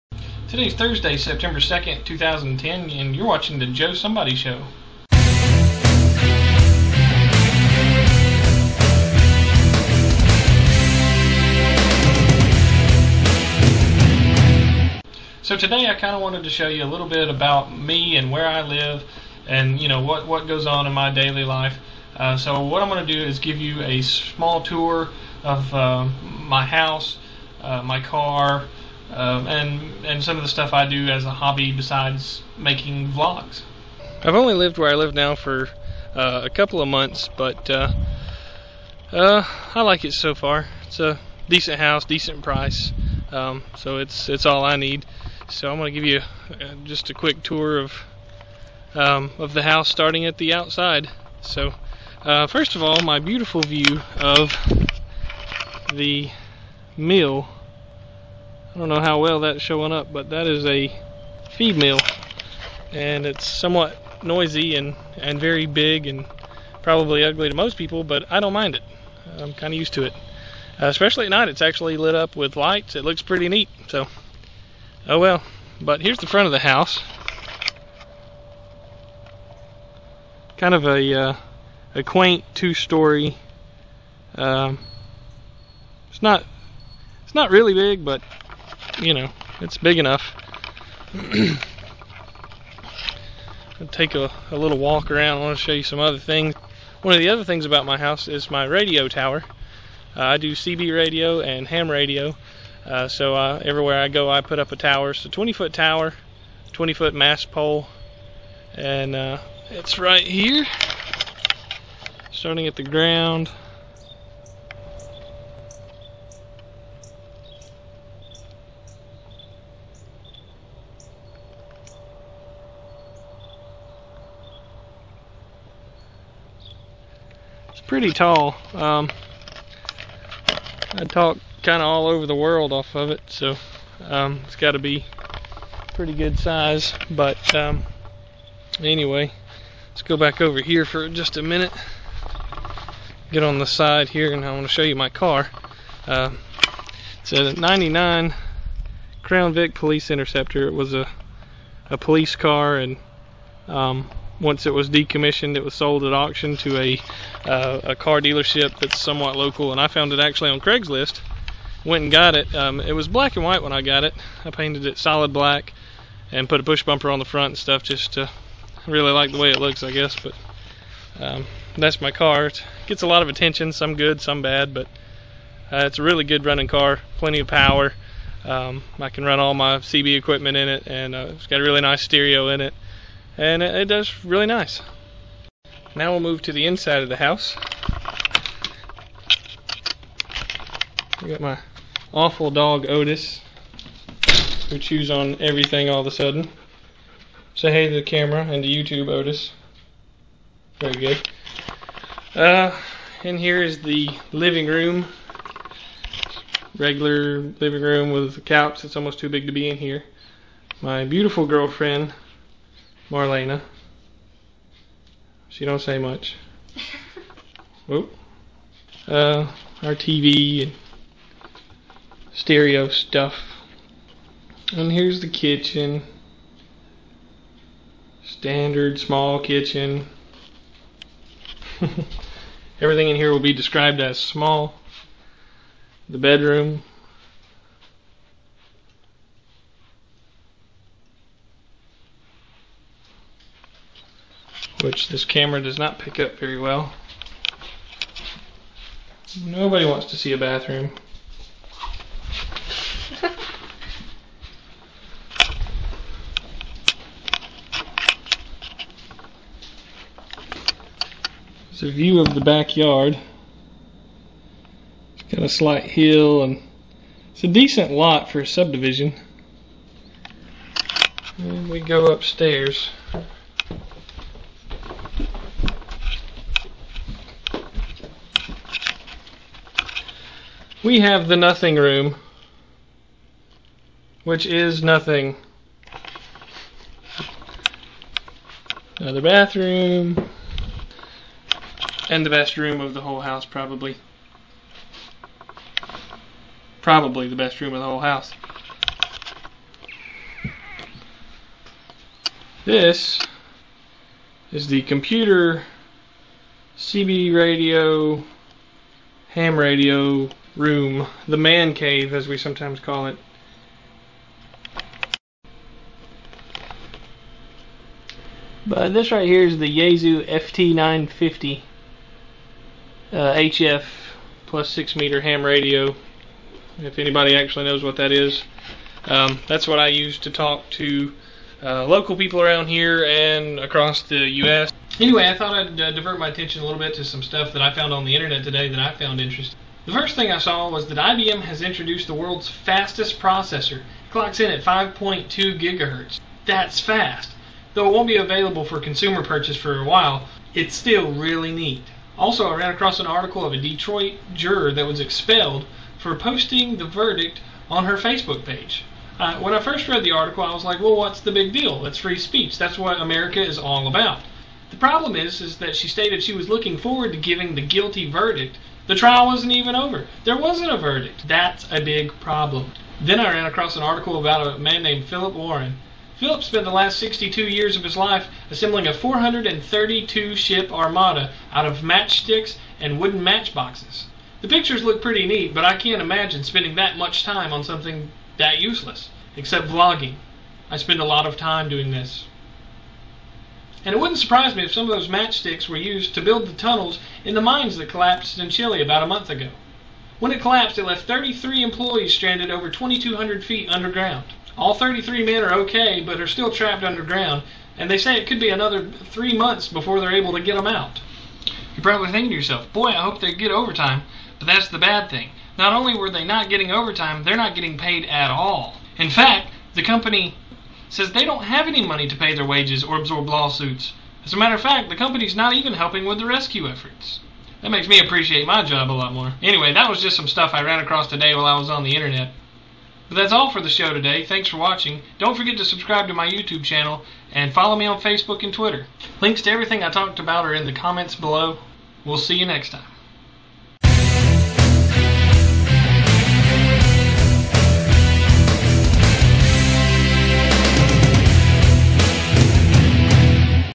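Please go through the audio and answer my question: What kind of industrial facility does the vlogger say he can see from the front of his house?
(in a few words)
feed mill.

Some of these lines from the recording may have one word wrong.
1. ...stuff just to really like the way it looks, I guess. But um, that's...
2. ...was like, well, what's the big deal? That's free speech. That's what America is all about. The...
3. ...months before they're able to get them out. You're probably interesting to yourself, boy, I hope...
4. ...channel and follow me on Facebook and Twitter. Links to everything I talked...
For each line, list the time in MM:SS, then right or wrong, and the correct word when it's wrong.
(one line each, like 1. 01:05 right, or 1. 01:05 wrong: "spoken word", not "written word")
1. 02:47 right
2. 06:00 right
3. 06:49 wrong: "thinking", not "interesting"
4. 07:16 right.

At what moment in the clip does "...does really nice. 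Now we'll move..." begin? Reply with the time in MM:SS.
03:03.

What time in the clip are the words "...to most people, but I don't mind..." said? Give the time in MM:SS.
01:07.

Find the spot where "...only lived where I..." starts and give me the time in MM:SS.
00:34.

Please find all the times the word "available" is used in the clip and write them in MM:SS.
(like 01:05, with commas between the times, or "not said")
05:48.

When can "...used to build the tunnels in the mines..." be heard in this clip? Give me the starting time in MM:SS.
06:35.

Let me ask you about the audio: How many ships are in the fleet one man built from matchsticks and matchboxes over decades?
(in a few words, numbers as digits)
432.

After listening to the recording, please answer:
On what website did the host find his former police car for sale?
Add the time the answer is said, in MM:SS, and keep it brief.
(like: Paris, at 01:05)
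Craigslist, at 02:40.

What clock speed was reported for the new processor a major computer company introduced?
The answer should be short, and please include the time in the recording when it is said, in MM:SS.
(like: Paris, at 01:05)
5.2 gigahertz, at 05:44.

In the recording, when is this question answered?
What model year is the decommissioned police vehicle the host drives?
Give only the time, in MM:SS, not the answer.
02:27.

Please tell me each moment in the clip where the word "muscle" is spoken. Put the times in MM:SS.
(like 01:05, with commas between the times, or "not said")
not said.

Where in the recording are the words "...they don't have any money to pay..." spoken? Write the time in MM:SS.
07:01.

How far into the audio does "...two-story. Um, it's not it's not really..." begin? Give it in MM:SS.
01:22.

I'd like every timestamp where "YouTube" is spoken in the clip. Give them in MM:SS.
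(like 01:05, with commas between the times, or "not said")
03:18, 07:16.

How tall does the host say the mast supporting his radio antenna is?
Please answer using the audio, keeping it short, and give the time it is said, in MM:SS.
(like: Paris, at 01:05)
20 foot, at 01:46.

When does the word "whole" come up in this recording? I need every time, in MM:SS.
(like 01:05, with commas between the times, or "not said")
04:53, 04:57.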